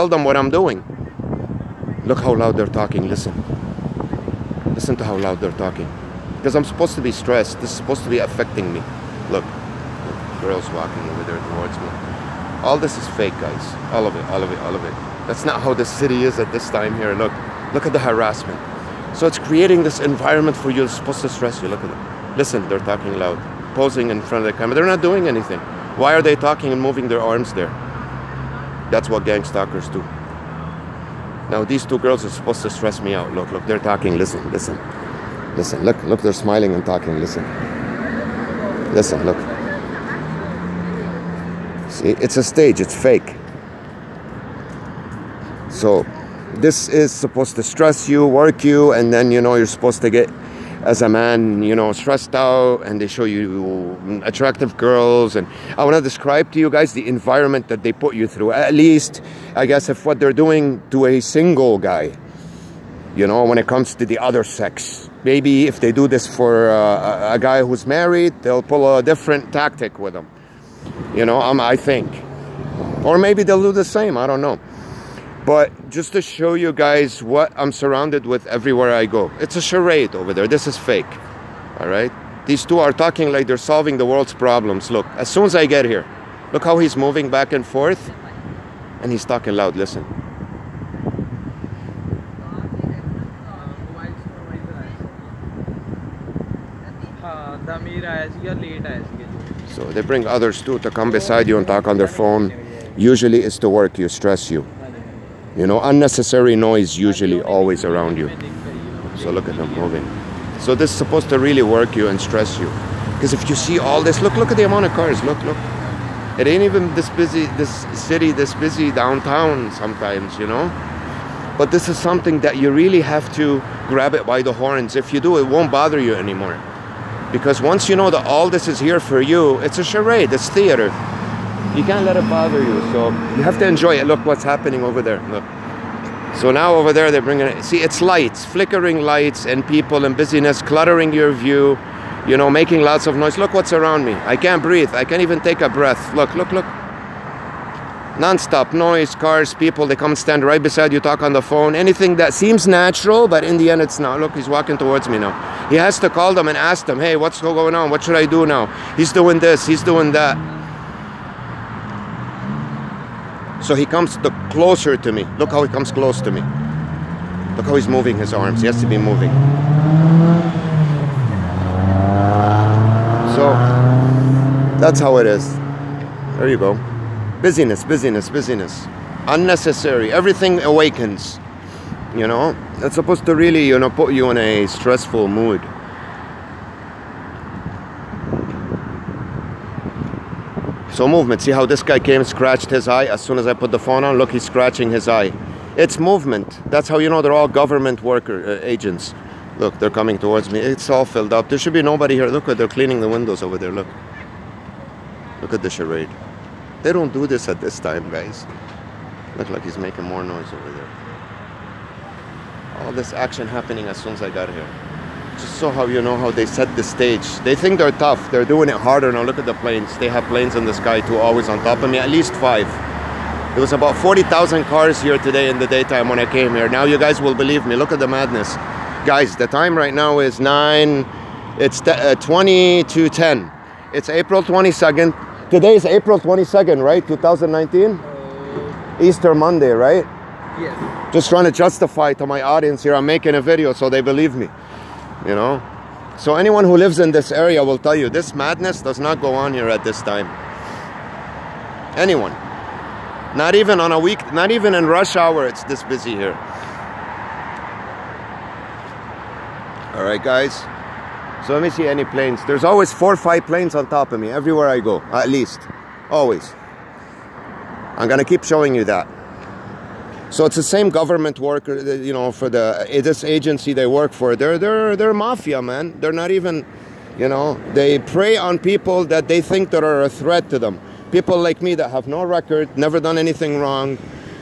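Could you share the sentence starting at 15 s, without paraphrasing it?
That's not how the city is at this time here.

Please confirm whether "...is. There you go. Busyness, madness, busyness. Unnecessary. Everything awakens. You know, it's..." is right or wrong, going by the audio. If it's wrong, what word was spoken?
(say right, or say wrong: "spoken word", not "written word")
wrong: "busyness", not "madness".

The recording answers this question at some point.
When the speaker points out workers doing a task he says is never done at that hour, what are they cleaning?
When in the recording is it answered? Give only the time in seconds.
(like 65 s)
203 s.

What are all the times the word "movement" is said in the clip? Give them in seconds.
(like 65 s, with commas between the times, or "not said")
191 s, 195 s.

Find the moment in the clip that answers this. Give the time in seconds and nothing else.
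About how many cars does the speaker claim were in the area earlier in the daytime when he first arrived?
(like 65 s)
223 s.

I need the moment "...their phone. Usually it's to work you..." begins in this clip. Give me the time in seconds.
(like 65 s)
101 s.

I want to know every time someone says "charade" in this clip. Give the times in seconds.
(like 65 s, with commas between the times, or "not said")
79 s, 129 s, 205 s.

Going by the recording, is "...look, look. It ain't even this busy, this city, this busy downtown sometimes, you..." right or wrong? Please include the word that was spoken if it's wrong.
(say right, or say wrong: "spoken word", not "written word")
right.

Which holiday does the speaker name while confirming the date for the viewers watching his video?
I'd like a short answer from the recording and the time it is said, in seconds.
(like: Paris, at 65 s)
Easter Monday, at 239 s.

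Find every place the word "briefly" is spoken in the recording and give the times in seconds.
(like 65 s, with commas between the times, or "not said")
not said.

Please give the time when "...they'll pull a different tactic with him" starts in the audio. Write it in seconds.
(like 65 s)
68 s.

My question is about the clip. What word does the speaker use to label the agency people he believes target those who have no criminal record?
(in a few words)
mafia.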